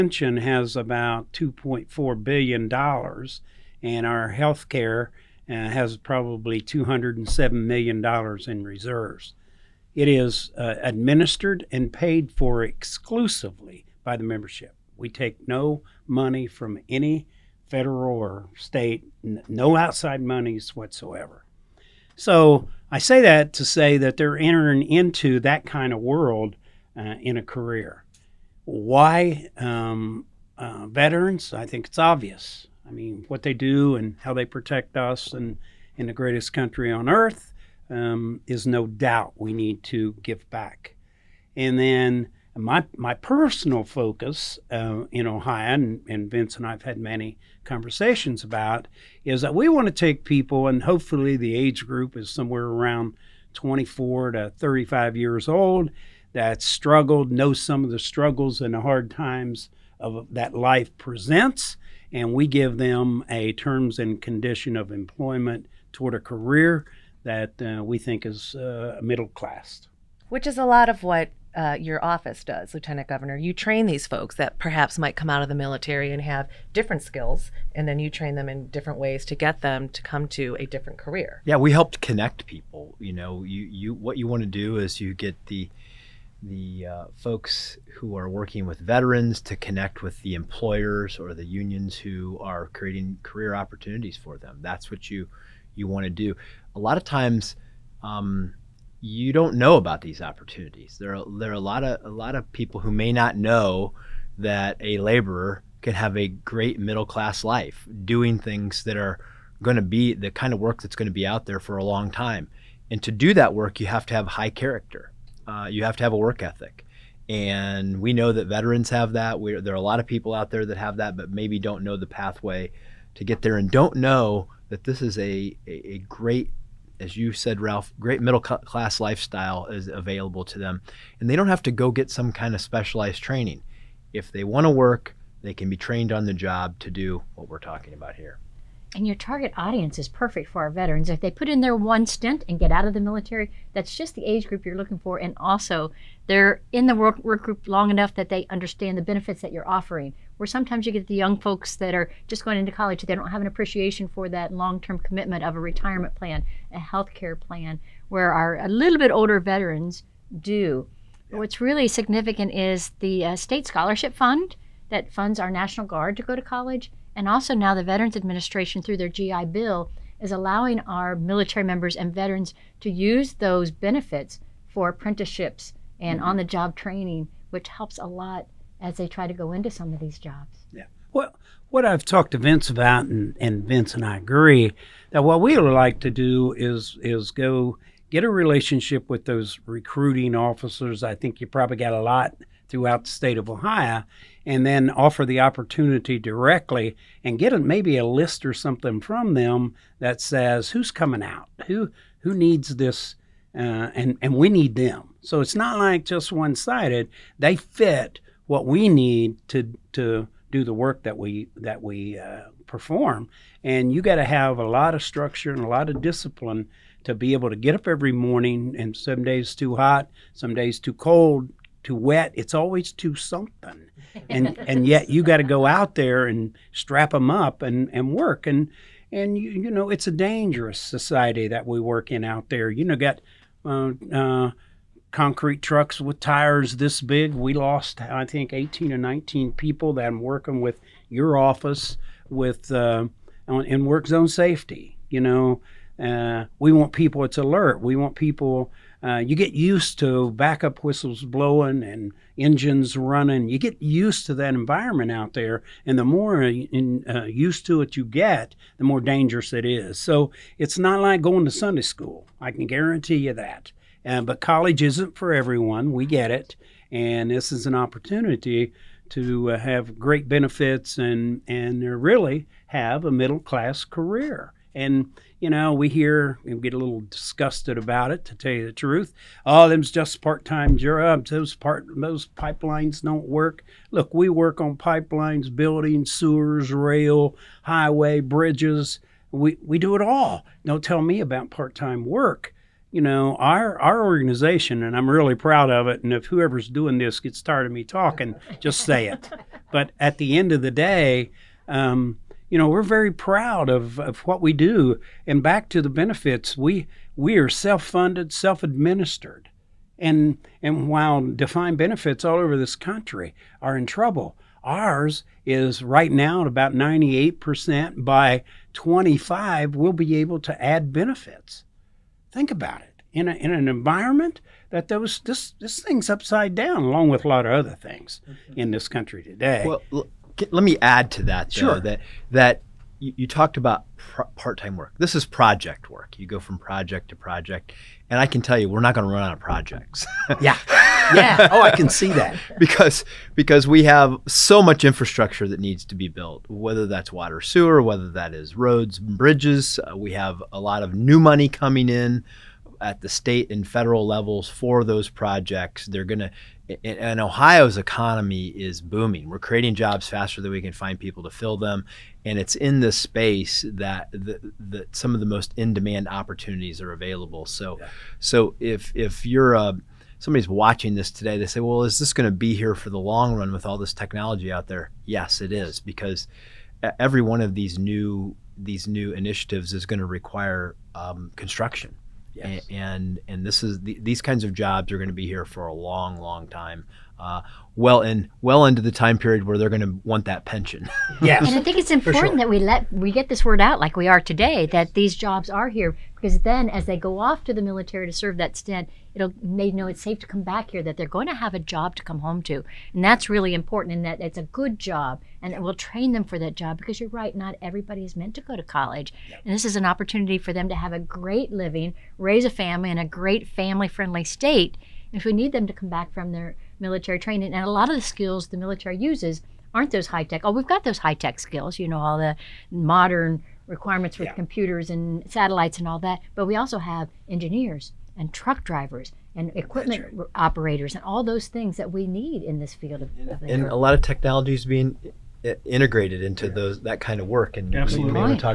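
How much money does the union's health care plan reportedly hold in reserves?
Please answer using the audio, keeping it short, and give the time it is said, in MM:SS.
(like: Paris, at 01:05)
$207 million, at 00:06.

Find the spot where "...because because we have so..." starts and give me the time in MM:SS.
05:42.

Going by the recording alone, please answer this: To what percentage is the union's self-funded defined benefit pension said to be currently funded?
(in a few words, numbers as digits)
98%.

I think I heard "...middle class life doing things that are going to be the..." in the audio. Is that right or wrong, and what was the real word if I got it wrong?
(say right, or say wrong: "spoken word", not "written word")
right.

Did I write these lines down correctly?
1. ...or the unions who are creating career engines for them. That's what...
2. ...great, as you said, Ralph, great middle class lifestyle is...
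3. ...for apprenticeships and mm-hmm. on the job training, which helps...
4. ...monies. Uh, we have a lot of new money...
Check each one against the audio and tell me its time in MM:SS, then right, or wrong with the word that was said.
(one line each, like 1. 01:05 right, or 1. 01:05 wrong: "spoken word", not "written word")
1. 01:31 wrong: "opportunities", not "engines"
2. 02:06 right
3. 02:54 right
4. 05:48 wrong: "bridges", not "monies".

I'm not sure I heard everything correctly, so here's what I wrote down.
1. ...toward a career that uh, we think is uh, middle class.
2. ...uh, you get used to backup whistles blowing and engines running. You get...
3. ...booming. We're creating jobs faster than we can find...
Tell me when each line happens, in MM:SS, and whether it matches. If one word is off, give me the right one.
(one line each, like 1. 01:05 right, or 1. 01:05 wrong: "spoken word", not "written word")
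1. 01:05 right
2. 04:09 right
3. 05:58 right.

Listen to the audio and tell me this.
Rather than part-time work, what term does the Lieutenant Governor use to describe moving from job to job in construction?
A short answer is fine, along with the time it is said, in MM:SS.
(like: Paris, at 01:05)
project work, at 05:35.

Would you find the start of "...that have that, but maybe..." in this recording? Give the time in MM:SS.
02:00.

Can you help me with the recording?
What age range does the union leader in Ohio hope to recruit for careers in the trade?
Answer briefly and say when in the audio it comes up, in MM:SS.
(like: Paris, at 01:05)
24 to 35, at 00:53.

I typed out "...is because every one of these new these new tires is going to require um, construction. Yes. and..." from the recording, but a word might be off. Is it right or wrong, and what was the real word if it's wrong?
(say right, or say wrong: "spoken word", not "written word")
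wrong: "initiatives", not "tires".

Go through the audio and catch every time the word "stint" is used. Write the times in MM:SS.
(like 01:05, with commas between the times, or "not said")
02:22, 06:38.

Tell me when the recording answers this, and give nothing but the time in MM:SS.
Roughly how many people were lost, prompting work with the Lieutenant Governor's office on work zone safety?
03:58.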